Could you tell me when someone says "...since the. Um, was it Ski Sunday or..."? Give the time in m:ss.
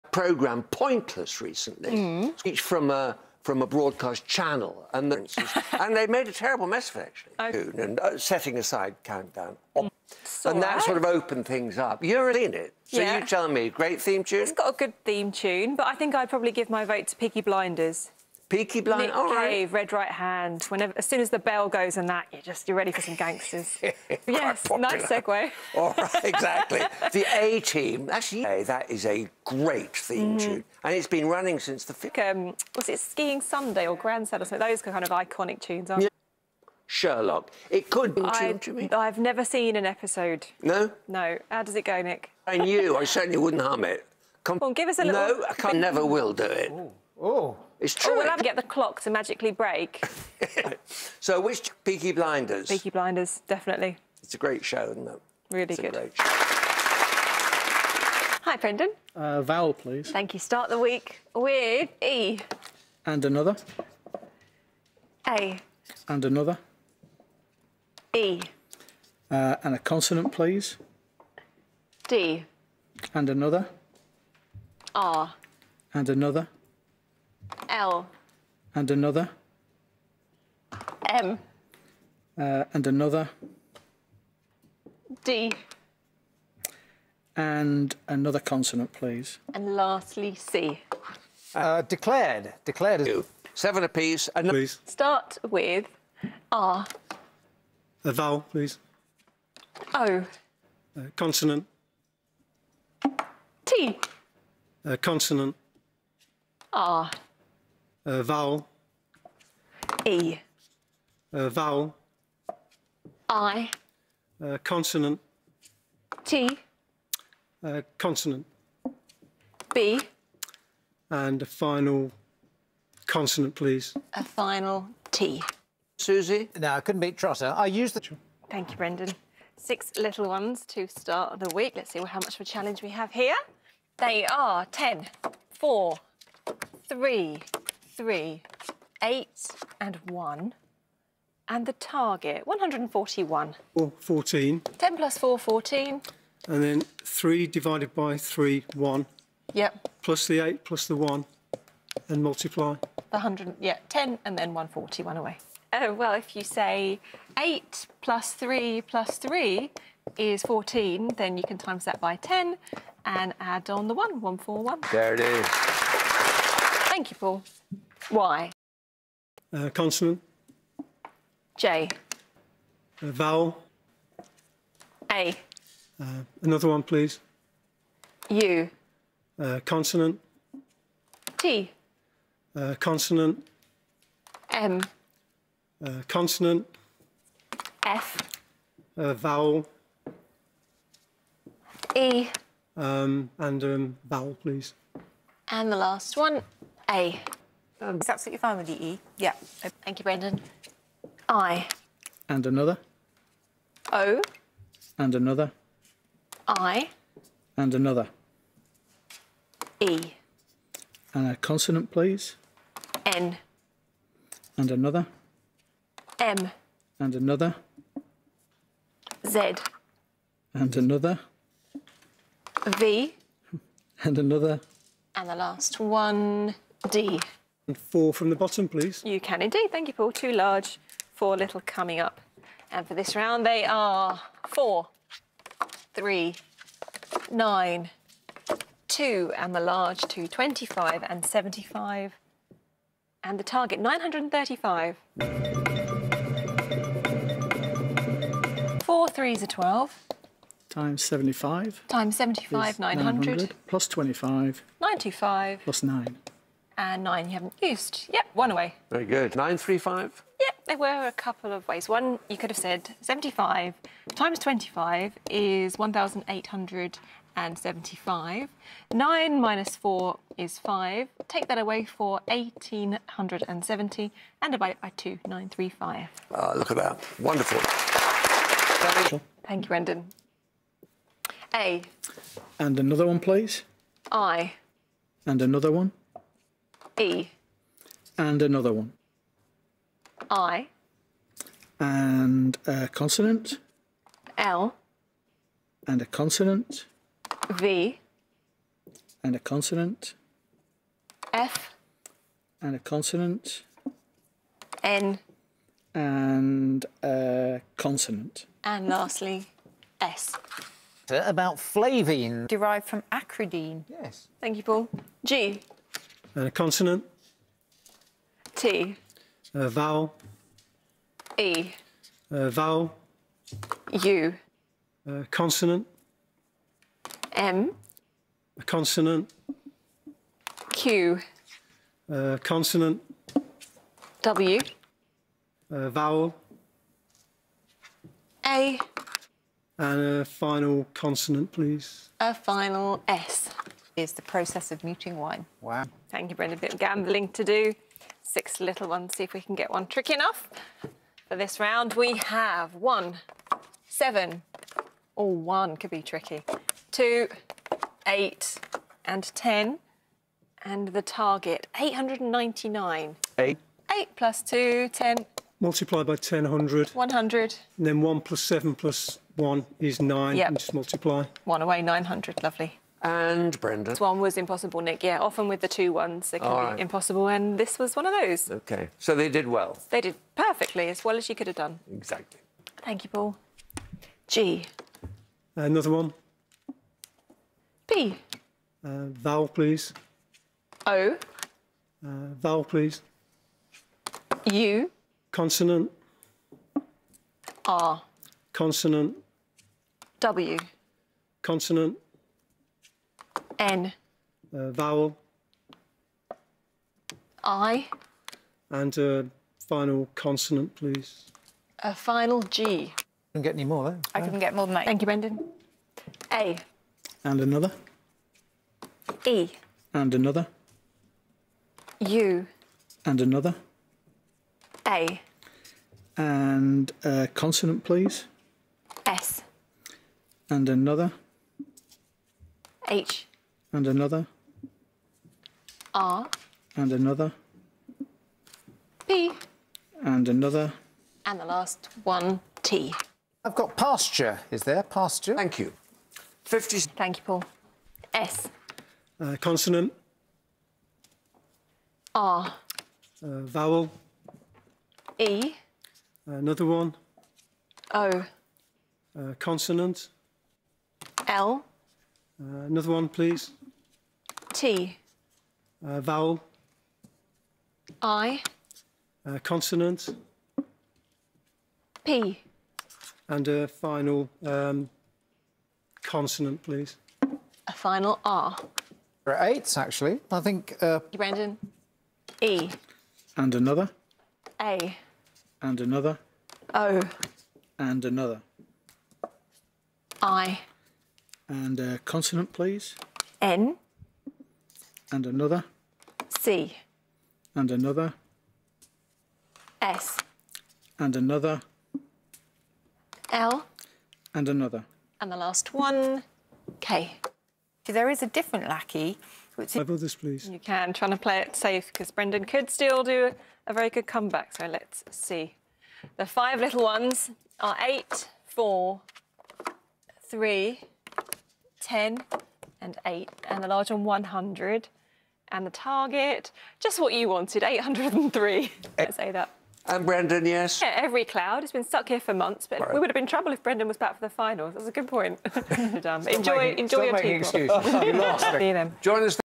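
0:31.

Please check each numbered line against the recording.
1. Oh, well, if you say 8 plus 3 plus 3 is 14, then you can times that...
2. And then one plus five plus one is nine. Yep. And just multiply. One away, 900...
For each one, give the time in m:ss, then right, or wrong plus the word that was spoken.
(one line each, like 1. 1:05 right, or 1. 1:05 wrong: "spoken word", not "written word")
1. 2:35 right
2. 6:07 wrong: "seven", not "five".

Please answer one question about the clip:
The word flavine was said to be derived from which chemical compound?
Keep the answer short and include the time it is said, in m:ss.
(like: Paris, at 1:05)
acridine, at 5:13.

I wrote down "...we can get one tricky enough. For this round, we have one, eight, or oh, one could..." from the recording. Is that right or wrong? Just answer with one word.
wrong.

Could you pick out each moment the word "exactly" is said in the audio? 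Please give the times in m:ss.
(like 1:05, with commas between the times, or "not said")
0:26, 6:21.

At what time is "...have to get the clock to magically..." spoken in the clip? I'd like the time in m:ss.
0:48.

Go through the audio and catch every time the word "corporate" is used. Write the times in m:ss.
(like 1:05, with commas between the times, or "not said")
not said.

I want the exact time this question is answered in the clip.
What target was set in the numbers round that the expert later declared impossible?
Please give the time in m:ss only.
6:01.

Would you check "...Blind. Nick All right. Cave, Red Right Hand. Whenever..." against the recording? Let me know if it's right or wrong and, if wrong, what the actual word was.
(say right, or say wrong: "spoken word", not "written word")
right.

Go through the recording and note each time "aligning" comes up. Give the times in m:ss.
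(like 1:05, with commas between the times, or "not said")
not said.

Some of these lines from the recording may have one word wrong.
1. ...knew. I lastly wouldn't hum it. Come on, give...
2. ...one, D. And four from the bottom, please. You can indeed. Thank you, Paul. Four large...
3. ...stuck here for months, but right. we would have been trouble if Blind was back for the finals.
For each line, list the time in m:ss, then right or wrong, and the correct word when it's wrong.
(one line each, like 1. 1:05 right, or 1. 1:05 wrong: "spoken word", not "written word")
1. 0:42 wrong: "certainly", not "lastly"
2. 3:45 wrong: "Two", not "Four"
3. 8:51 wrong: "Brendan", not "Blind".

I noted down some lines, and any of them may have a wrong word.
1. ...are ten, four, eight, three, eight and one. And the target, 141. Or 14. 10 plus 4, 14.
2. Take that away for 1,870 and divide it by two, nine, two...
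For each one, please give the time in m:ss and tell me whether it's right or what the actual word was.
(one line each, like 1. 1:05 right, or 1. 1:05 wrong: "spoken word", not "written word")
1. 2:14 wrong: "three", not "eight"
2. 4:31 wrong: "three", not "two".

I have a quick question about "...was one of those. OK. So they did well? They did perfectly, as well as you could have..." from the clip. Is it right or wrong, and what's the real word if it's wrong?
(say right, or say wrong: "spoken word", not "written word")
right.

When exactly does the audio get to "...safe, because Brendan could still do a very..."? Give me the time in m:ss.
8:31.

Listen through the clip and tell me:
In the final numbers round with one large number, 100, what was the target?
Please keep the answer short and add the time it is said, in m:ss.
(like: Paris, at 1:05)
803, at 8:47.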